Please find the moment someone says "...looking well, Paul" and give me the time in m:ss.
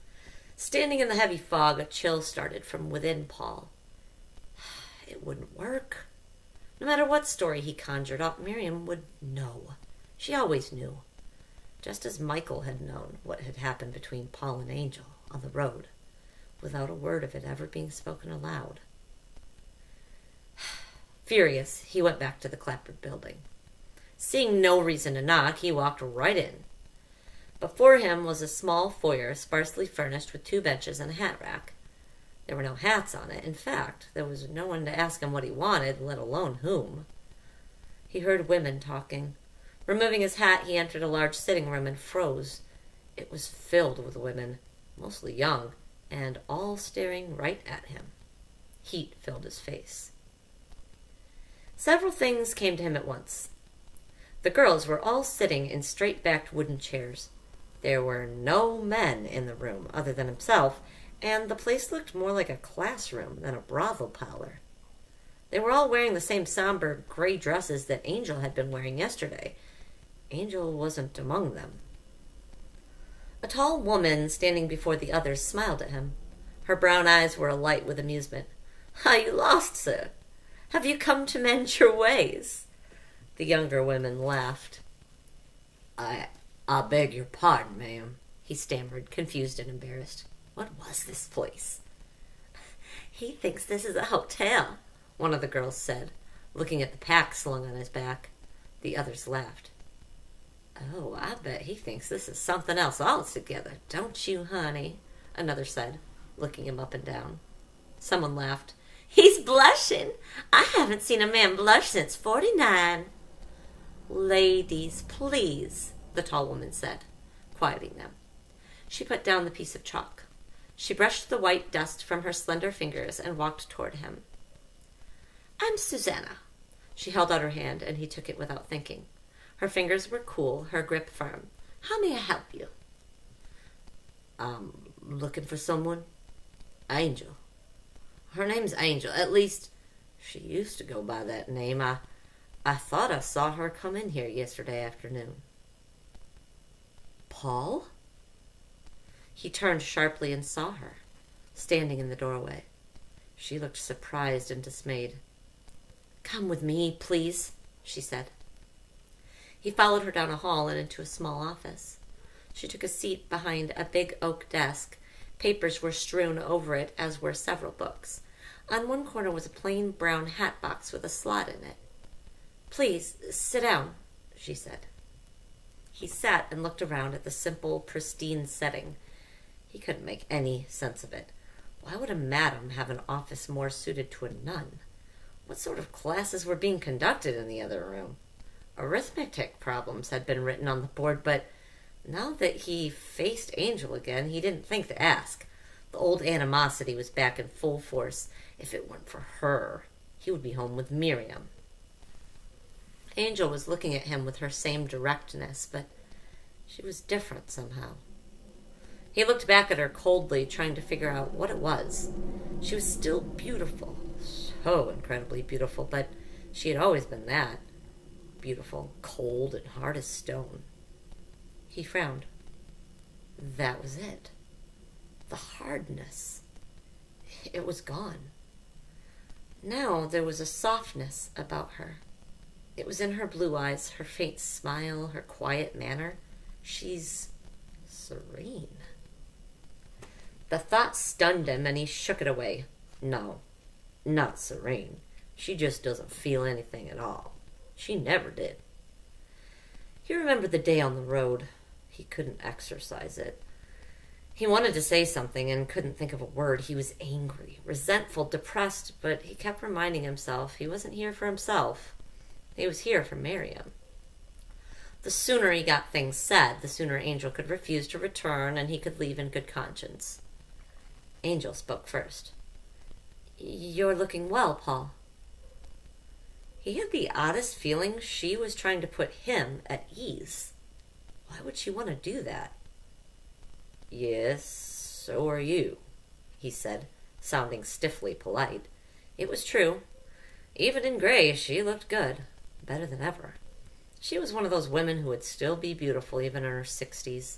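4:33.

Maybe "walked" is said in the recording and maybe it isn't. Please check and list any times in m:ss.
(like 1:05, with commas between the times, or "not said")
0:25, 2:03.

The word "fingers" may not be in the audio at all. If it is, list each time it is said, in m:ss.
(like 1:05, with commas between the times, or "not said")
2:02, 2:09.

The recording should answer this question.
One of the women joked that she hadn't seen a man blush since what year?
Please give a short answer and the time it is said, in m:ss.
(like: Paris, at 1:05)
49, at 1:51.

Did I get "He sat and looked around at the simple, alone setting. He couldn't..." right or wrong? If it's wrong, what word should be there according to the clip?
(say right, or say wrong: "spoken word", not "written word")
wrong: "pristine", not "alone".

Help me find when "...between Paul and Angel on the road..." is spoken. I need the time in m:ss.
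0:13.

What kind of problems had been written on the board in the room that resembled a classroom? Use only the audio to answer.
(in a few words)
Arithmetic.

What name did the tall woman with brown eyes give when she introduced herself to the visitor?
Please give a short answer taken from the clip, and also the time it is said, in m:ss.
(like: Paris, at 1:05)
Susanna, at 2:05.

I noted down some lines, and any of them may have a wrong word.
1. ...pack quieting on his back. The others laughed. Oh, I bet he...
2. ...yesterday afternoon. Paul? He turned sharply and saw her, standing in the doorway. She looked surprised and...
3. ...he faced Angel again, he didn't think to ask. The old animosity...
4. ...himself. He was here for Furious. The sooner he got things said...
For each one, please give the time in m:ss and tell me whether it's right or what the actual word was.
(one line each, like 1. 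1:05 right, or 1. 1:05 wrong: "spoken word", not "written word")
1. 1:36 wrong: "slung", not "quieting"
2. 2:24 right
3. 3:12 right
4. 4:21 wrong: "Miriam", not "Furious".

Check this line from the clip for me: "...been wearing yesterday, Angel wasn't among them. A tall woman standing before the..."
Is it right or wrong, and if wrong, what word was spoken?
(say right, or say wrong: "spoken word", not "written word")
right.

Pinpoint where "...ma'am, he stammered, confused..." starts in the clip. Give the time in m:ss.
1:27.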